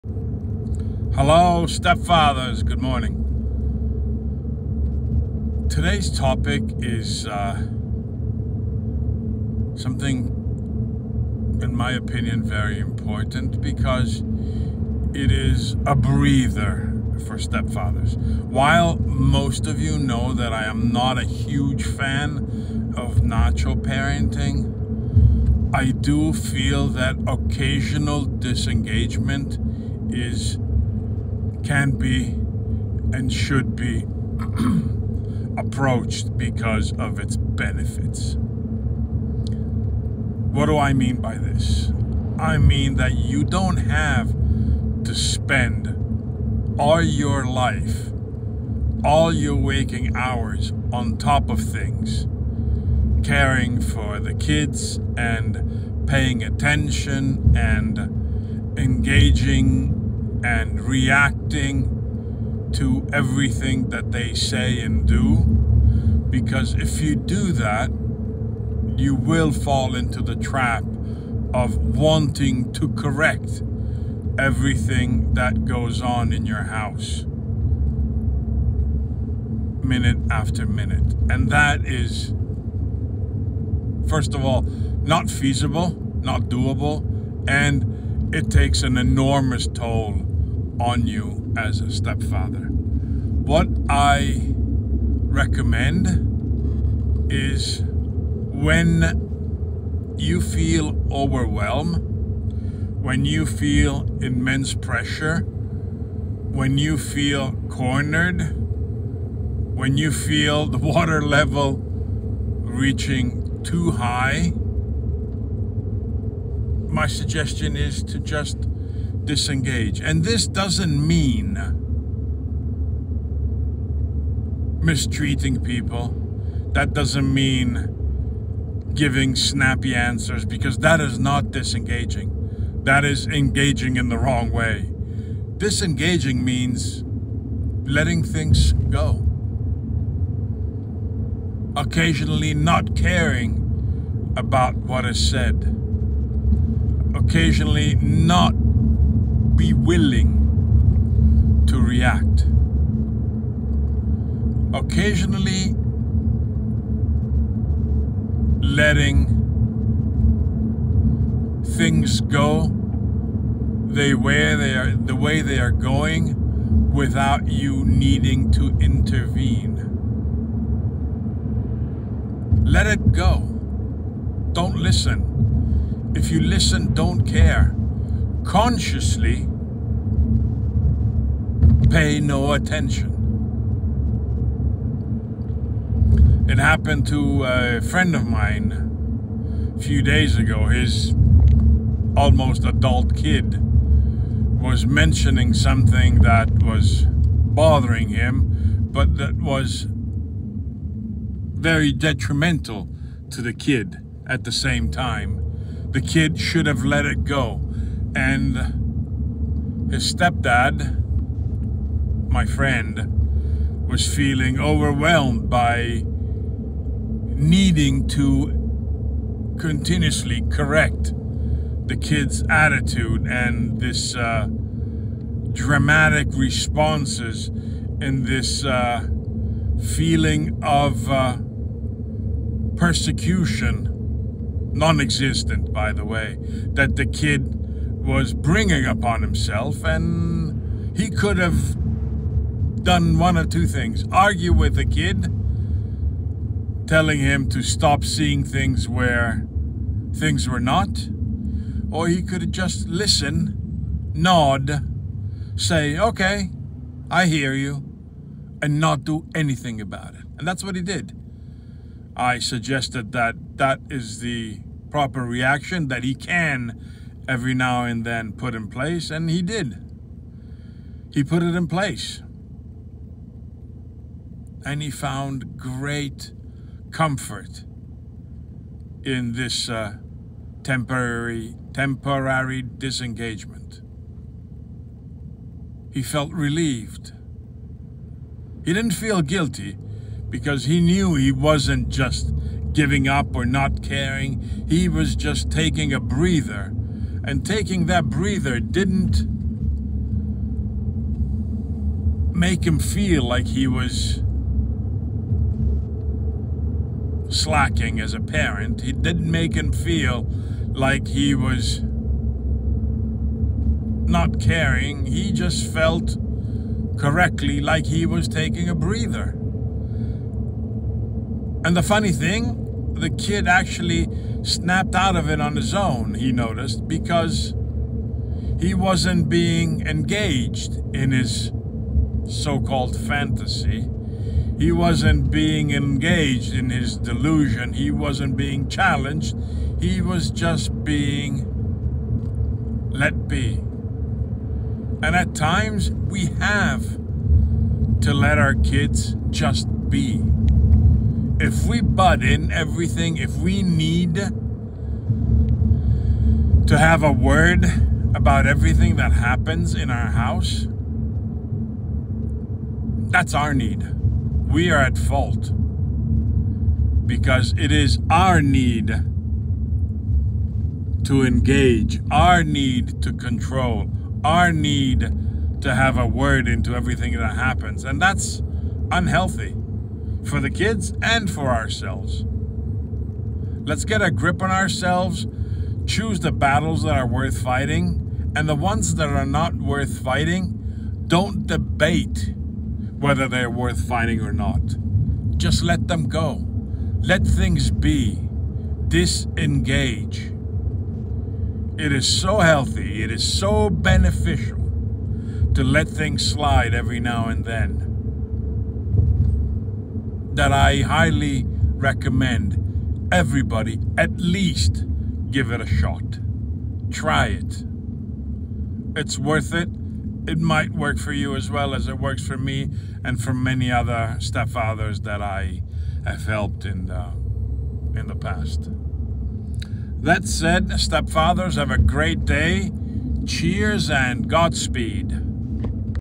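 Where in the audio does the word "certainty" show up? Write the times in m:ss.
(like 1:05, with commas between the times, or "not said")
not said.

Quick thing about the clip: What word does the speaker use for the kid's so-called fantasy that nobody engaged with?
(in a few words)
delusion.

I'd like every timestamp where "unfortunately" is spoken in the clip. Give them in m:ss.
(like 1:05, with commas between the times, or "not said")
not said.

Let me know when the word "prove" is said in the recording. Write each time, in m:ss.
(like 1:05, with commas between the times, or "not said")
not said.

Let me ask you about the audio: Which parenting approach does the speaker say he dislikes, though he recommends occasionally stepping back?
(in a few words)
nacho parenting.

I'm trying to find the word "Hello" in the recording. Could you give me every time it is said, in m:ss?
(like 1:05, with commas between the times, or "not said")
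0:01.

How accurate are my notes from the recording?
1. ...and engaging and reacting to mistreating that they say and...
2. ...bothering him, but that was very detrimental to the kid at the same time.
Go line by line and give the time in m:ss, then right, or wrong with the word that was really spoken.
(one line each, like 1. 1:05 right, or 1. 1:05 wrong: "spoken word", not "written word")
1. 0:57 wrong: "everything", not "mistreating"
2. 3:17 right.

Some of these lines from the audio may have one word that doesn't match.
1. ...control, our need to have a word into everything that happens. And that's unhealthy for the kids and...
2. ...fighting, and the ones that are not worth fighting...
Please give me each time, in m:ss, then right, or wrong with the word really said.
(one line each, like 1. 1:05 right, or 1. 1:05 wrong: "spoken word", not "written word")
1. 6:13 right
2. 6:27 right.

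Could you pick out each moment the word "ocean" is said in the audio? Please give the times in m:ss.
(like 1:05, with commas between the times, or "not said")
not said.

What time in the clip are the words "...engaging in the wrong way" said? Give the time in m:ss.
2:13.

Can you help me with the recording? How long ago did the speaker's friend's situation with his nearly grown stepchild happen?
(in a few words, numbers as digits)
a few days ago.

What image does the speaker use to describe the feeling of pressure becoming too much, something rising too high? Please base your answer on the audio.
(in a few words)
water level.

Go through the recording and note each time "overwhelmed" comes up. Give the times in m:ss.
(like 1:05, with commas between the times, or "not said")
1:41, 3:34.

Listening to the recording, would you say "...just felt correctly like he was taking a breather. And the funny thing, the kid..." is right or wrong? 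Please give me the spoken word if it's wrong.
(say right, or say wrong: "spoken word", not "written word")
right.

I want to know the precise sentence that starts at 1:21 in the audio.
And that is, first of all, not feasible, not doable, and it takes an enormous toll on you as a stepfather.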